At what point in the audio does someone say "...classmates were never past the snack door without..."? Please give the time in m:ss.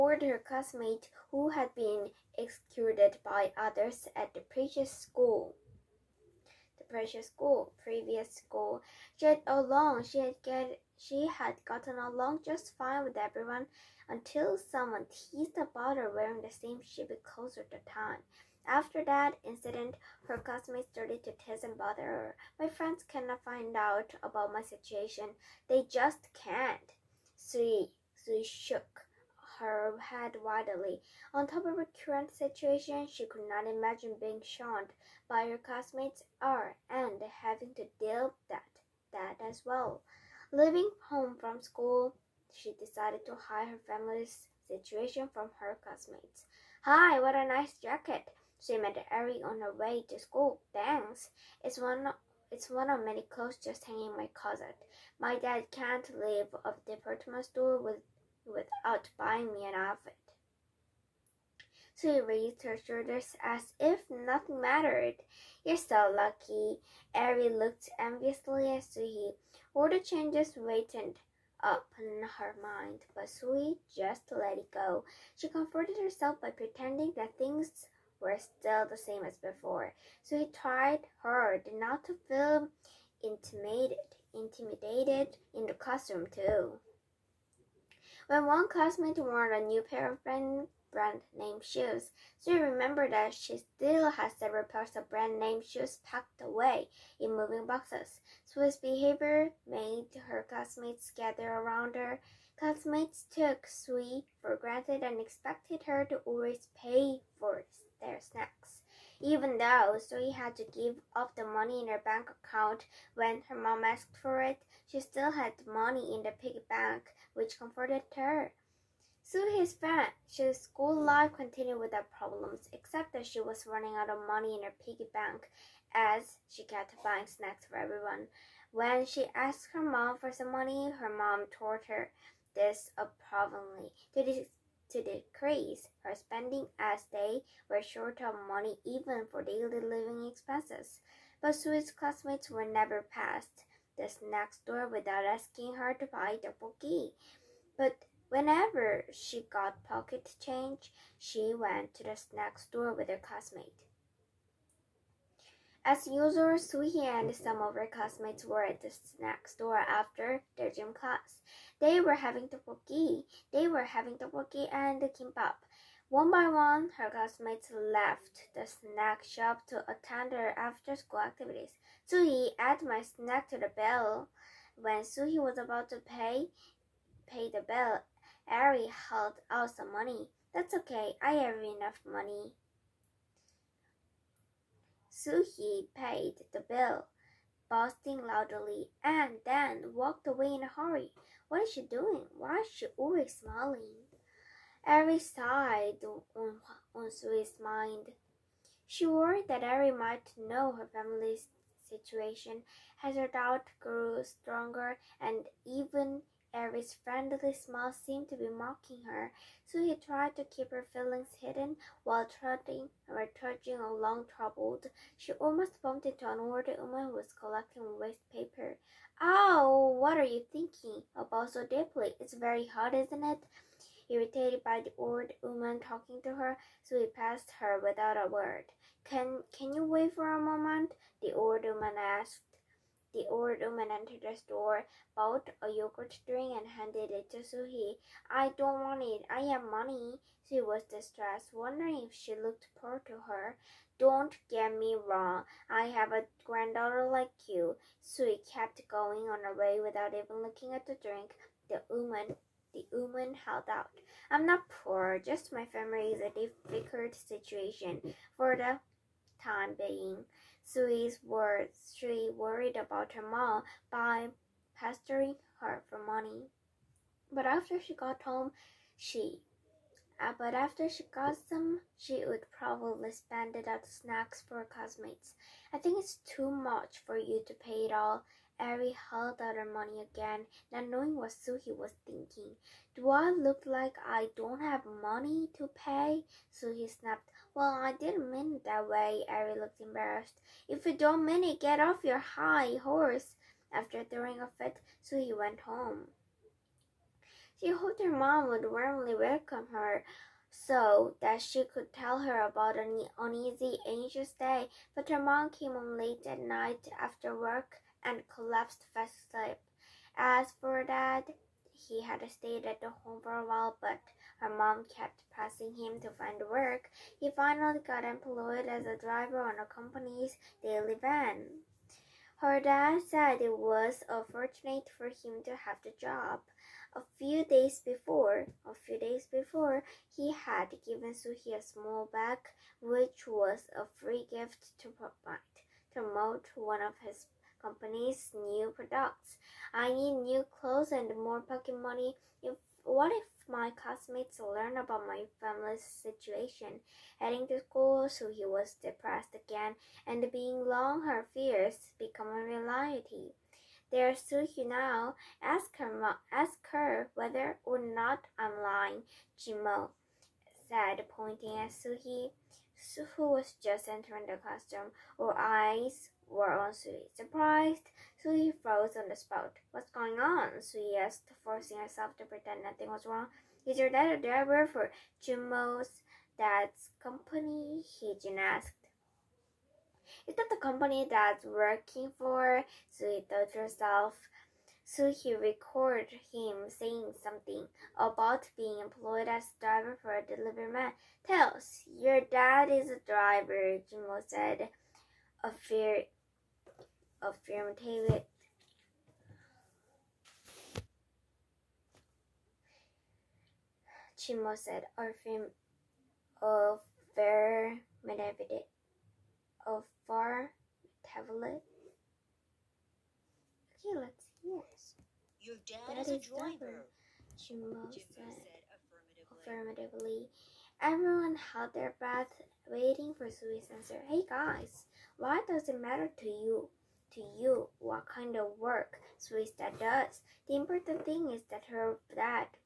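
2:21.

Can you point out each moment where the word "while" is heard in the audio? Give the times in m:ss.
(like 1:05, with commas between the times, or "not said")
3:32, 5:13.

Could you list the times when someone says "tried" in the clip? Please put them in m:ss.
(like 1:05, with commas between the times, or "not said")
1:20, 3:29.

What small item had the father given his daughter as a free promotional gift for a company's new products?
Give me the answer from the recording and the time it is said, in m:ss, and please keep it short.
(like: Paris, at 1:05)
small bag, at 5:31.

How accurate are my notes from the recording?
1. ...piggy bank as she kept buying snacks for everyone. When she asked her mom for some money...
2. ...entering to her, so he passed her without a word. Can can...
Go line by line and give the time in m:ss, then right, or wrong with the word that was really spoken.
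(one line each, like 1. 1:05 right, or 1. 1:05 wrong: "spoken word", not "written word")
1. 2:04 right
2. 3:45 wrong: "talking", not "entering".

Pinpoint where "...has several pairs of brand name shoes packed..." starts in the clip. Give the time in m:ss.
1:34.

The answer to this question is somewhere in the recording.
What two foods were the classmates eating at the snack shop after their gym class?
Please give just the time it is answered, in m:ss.
2:44.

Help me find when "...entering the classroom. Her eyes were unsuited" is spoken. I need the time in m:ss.
6:03.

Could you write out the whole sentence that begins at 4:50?
If you don't mean it, get off your high horse.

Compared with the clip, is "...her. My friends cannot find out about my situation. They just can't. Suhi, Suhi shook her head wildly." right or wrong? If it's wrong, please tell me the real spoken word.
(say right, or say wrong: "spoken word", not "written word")
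right.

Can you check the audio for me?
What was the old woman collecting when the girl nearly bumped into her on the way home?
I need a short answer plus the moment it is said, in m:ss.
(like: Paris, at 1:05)
waste paper, at 3:37.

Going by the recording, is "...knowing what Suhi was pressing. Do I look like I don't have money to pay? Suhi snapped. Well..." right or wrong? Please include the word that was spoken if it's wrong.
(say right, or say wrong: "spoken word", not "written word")
wrong: "thinking", not "pressing".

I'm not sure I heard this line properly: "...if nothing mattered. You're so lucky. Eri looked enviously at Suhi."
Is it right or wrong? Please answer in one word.
right.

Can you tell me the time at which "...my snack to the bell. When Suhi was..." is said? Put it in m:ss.
2:52.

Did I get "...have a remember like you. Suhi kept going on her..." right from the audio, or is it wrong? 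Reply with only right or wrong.
wrong.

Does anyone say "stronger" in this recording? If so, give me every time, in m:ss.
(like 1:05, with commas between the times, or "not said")
3:24.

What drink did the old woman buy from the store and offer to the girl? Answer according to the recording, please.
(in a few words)
yogurt drink.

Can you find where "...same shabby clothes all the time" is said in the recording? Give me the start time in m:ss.
0:16.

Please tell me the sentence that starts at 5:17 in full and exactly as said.
He finally got employed as a driver on a company's daily van.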